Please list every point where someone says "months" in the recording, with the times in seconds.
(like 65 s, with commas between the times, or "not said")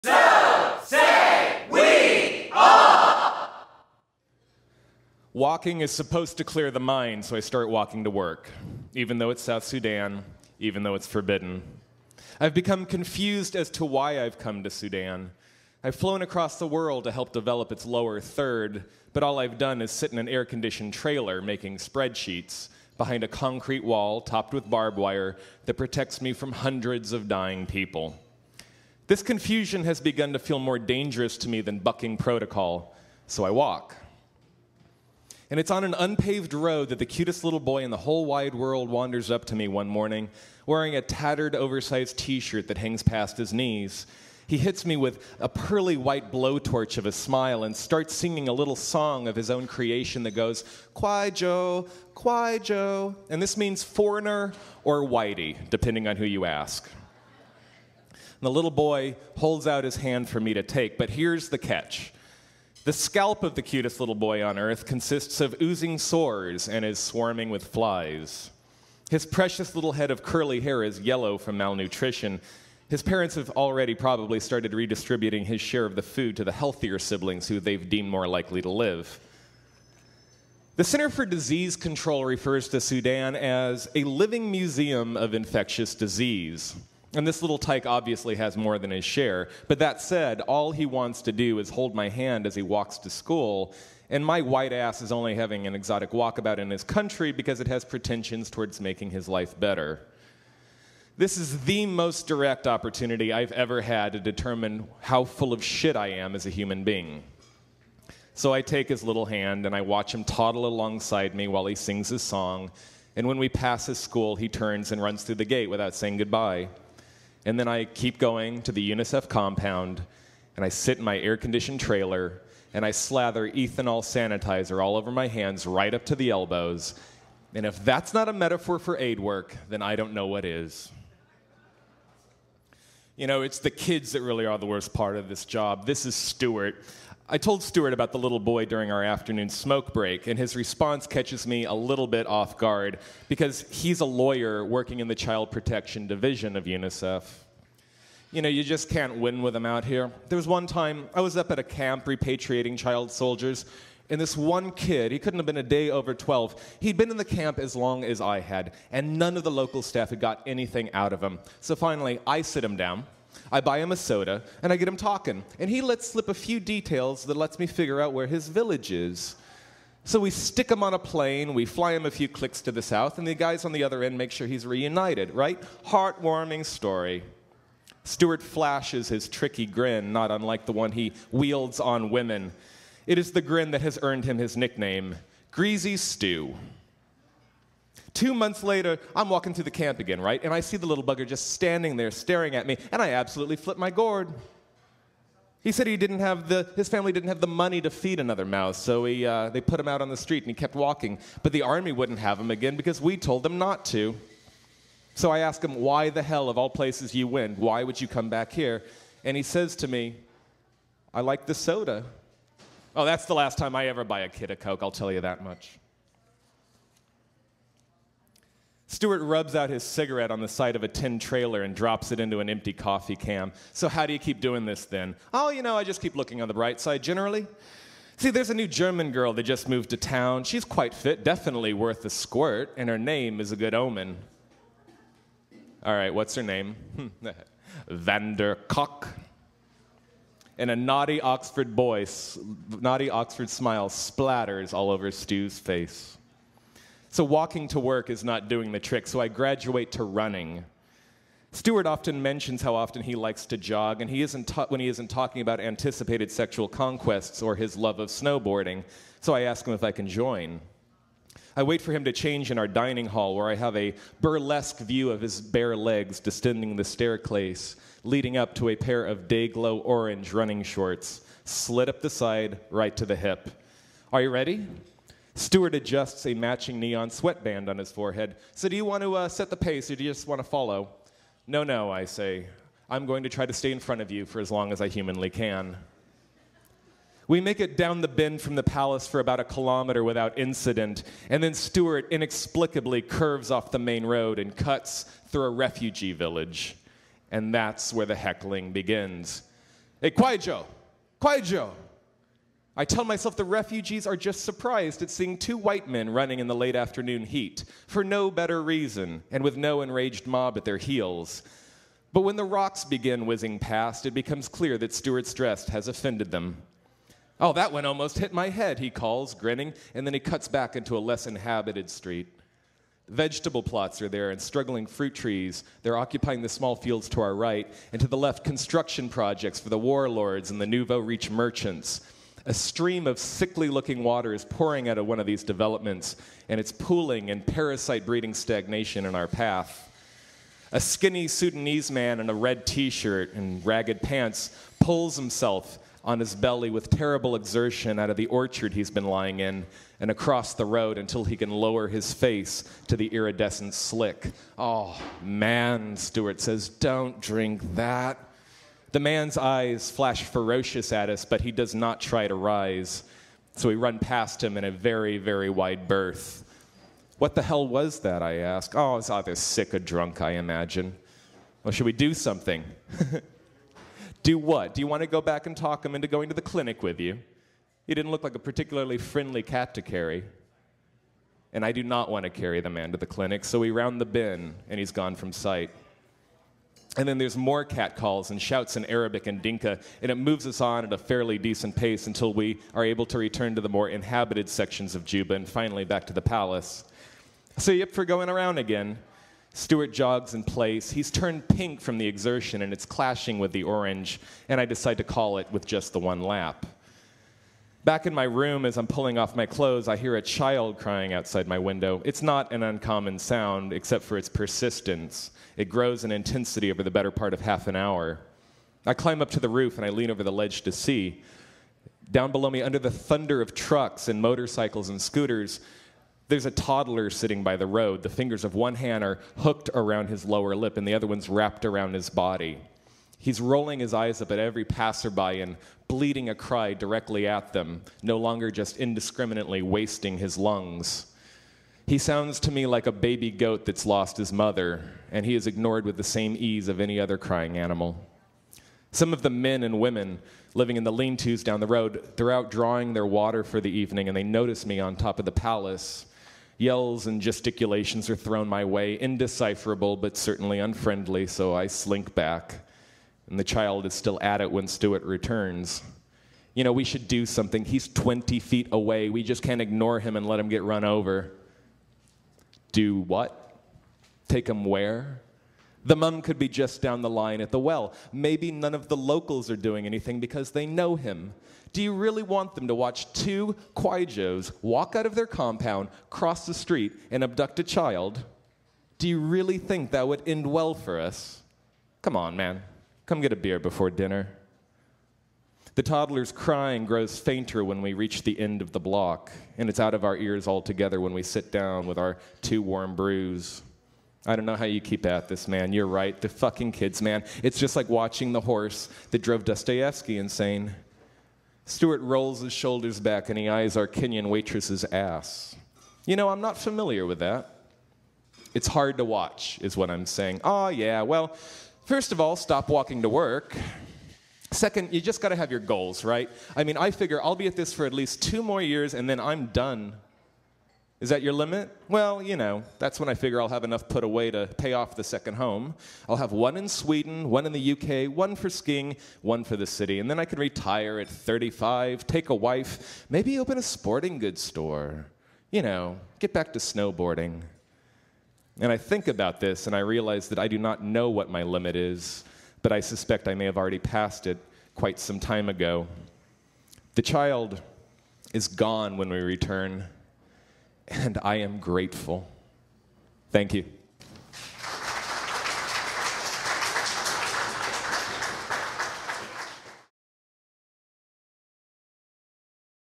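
188 s.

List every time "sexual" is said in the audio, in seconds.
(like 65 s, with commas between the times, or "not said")
256 s.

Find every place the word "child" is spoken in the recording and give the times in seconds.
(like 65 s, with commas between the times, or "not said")
145 s, 152 s, 410 s, 463 s, 487 s, 557 s.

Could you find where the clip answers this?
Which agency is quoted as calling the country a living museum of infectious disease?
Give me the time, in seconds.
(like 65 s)
80 s.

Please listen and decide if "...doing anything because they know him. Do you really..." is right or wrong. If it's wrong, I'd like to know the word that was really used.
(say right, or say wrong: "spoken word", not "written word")
right.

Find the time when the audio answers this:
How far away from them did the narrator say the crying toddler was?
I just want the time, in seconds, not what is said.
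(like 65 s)
467 s.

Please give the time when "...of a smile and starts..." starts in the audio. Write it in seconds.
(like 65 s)
46 s.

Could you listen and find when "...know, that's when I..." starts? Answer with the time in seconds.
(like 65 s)
532 s.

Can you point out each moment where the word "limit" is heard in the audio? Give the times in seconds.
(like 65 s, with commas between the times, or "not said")
531 s, 551 s.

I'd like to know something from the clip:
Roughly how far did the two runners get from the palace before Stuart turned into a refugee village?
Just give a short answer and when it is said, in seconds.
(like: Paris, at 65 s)
1 kilometer, at 289 s.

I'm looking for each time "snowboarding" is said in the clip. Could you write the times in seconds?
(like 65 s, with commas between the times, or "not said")
258 s, 546 s.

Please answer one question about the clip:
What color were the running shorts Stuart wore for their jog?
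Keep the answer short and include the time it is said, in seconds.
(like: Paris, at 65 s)
Day glow orange, at 269 s.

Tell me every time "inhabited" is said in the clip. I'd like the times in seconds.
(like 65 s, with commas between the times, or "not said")
321 s, 393 s.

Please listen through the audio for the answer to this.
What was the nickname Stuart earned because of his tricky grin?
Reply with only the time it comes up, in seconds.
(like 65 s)
185 s.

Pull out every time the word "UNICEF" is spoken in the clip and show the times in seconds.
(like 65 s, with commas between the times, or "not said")
118 s, 146 s.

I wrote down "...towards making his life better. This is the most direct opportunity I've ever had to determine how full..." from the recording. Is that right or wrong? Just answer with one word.
right.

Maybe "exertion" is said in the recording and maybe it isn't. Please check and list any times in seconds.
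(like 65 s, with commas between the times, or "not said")
347 s, 402 s.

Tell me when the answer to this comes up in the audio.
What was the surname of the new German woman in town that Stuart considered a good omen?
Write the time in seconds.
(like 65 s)
237 s.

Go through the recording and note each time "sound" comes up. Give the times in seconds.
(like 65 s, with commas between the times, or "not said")
413 s, 441 s.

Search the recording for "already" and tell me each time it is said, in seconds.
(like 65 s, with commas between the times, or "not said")
73 s, 553 s.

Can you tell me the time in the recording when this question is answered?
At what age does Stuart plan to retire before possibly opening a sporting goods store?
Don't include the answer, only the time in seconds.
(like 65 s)
541 s.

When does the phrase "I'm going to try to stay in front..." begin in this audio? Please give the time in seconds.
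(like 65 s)
282 s.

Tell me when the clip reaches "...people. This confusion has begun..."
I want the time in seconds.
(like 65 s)
27 s.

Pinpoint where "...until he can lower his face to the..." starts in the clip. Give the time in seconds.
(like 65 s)
350 s.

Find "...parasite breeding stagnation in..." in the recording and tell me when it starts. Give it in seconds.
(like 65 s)
337 s.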